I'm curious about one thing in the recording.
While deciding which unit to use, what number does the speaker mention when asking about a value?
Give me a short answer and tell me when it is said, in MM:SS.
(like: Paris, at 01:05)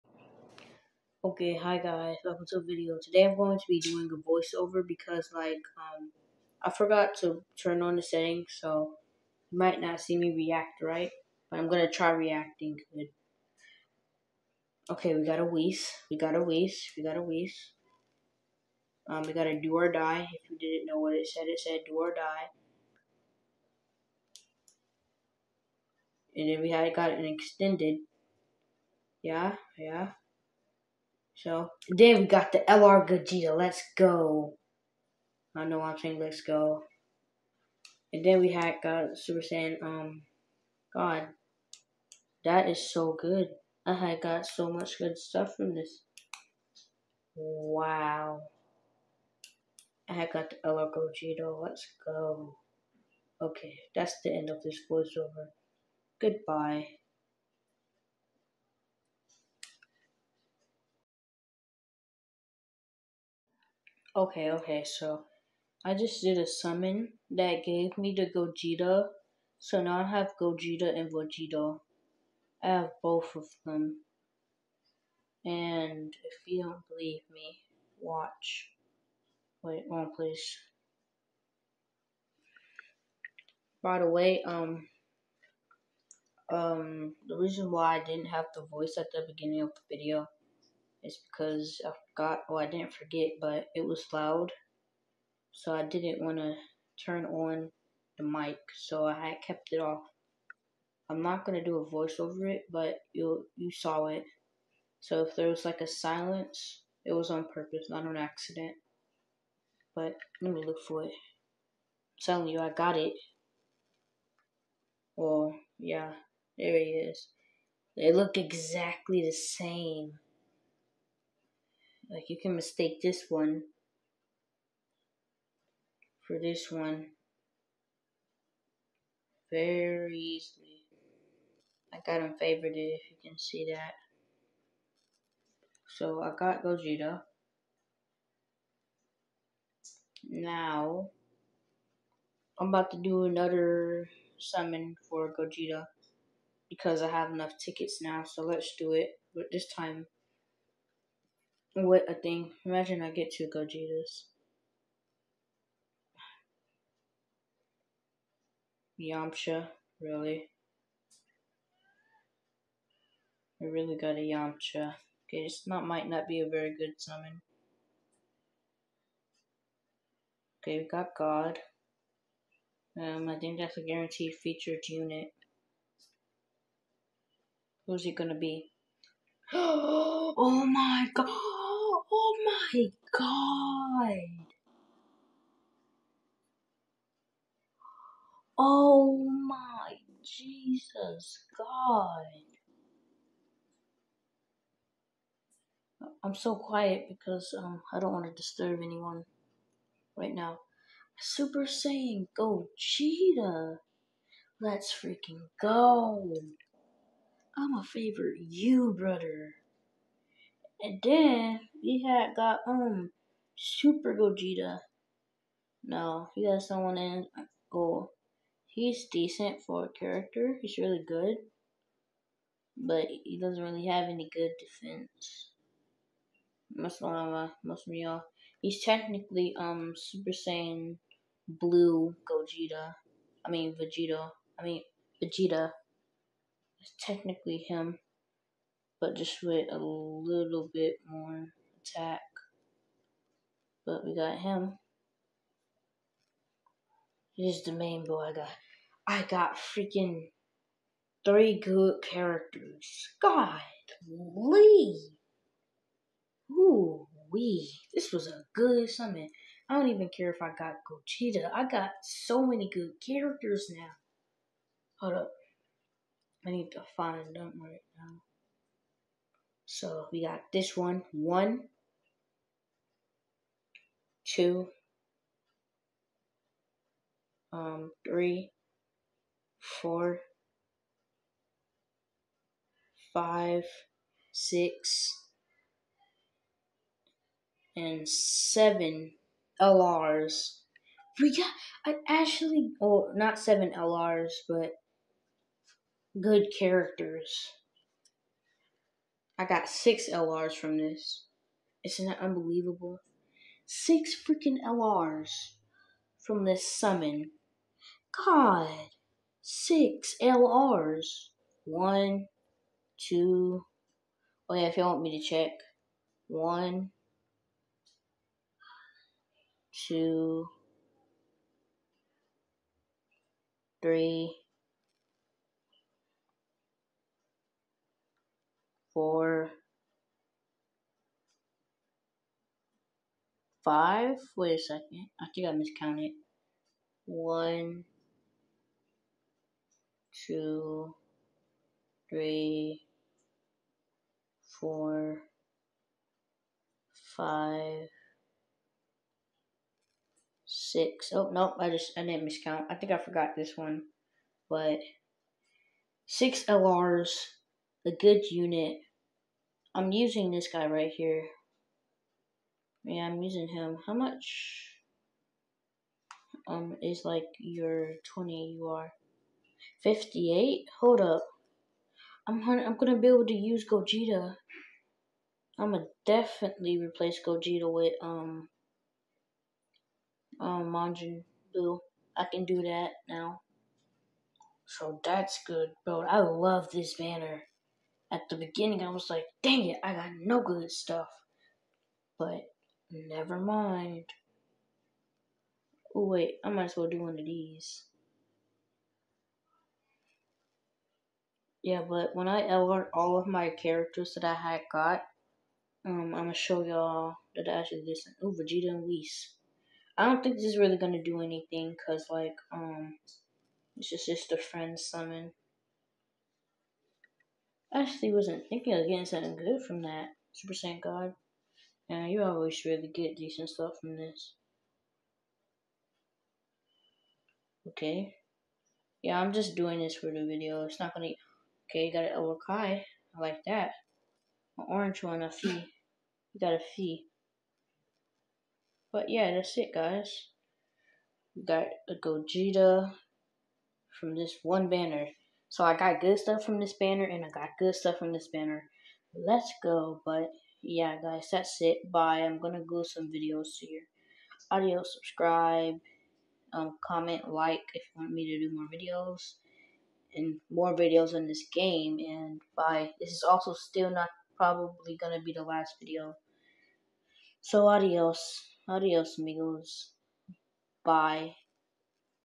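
58, at 06:09.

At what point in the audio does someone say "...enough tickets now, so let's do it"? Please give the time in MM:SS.
02:27.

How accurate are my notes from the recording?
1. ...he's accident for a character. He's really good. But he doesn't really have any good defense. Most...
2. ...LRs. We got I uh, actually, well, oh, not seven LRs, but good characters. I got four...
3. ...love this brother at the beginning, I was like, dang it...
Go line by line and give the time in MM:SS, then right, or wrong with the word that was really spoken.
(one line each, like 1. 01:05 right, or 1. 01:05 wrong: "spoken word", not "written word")
1. 03:38 wrong: "decent", not "accident"
2. 04:49 wrong: "six", not "four"
3. 06:26 wrong: "banner", not "brother".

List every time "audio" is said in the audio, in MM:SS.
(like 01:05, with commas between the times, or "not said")
07:34.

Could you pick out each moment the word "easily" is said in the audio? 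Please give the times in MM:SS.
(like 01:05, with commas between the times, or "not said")
02:10.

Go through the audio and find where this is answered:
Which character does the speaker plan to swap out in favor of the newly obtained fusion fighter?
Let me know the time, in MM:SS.
06:20.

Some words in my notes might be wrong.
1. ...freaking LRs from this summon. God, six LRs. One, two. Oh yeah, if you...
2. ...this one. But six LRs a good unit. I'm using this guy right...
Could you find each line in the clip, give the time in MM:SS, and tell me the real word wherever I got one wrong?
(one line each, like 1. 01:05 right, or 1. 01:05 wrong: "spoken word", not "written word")
1. 05:04 right
2. 05:53 right.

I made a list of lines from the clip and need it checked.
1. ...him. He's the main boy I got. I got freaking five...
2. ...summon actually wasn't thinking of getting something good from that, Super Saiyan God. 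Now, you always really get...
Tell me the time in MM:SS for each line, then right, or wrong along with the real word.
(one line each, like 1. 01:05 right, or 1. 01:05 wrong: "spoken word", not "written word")
1. 04:04 wrong: "three", not "five"
2. 06:54 right.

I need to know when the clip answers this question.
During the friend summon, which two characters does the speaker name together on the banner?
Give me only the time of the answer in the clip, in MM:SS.
06:48.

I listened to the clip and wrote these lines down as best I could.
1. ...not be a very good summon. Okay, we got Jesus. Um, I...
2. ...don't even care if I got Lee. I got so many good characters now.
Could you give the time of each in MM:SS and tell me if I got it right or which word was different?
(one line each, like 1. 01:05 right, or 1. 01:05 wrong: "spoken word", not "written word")
1. 02:46 wrong: "God", not "Jesus"
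2. 04:19 wrong: "Gogeta", not "Lee".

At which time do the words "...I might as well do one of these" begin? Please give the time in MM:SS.
06:36.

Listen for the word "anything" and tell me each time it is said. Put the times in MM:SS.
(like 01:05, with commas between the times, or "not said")
06:51.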